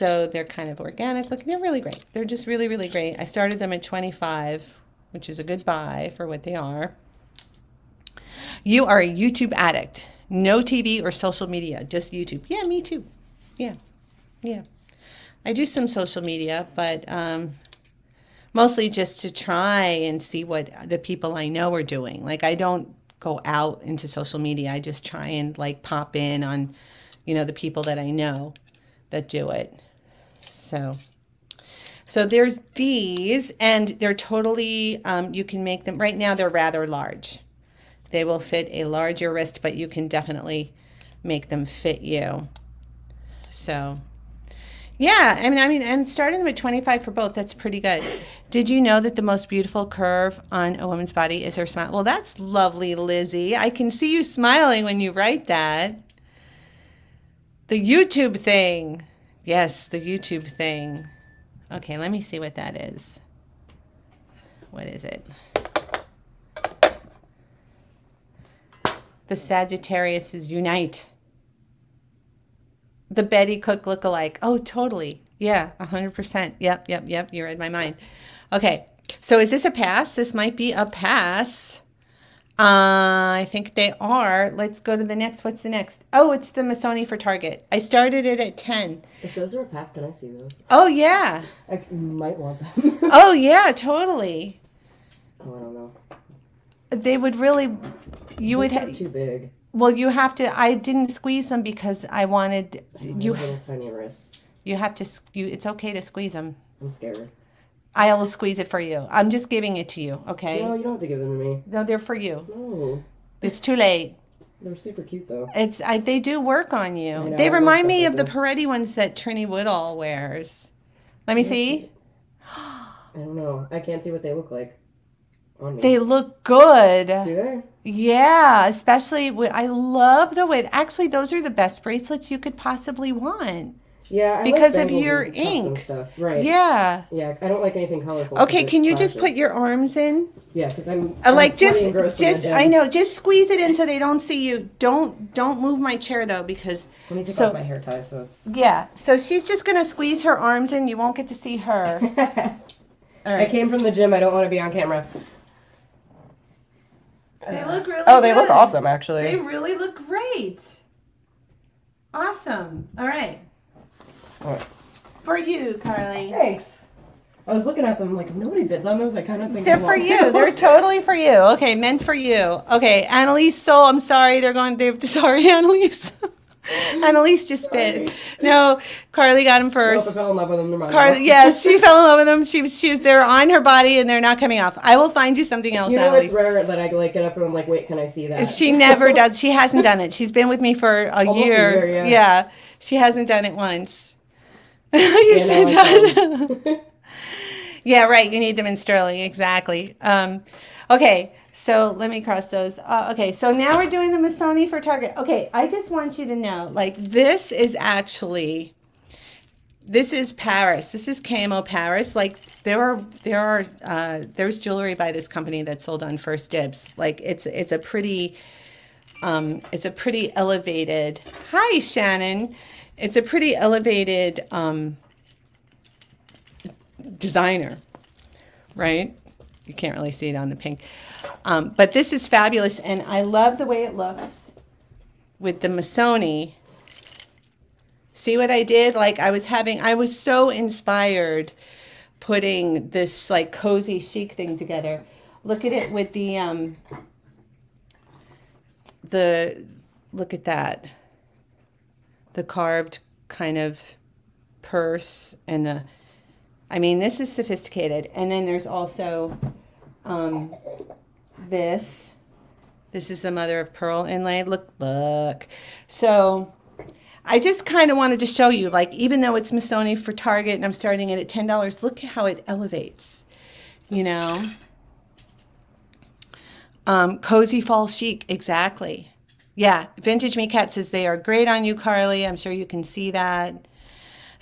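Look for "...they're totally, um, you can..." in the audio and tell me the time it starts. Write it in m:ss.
0:33.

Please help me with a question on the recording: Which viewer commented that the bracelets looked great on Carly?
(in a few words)
Vintage Me Cat.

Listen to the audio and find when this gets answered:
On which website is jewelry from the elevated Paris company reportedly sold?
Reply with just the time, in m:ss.
3:36.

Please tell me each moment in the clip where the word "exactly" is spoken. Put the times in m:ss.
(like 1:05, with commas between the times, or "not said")
3:19, 4:38.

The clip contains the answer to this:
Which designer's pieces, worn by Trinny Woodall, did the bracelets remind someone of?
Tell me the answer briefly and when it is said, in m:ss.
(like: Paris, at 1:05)
Peretti, at 1:58.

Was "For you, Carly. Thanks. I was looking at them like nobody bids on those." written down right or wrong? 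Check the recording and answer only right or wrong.
right.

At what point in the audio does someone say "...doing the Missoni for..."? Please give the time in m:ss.
3:23.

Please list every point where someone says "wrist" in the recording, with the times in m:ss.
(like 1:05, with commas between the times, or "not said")
0:39, 1:43.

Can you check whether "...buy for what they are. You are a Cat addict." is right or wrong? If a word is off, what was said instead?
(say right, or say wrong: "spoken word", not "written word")
wrong: "YouTube", not "Cat".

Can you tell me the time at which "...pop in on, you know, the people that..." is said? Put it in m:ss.
0:25.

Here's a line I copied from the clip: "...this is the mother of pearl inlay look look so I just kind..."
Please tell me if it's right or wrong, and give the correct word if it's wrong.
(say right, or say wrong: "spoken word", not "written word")
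right.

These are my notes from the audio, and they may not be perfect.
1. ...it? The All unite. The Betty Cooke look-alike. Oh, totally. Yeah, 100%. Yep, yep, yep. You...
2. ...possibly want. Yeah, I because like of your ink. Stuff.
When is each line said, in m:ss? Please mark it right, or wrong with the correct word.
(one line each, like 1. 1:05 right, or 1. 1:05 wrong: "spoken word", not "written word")
1. 1:05 wrong: "Sagittarius", not "All"
2. 2:12 right.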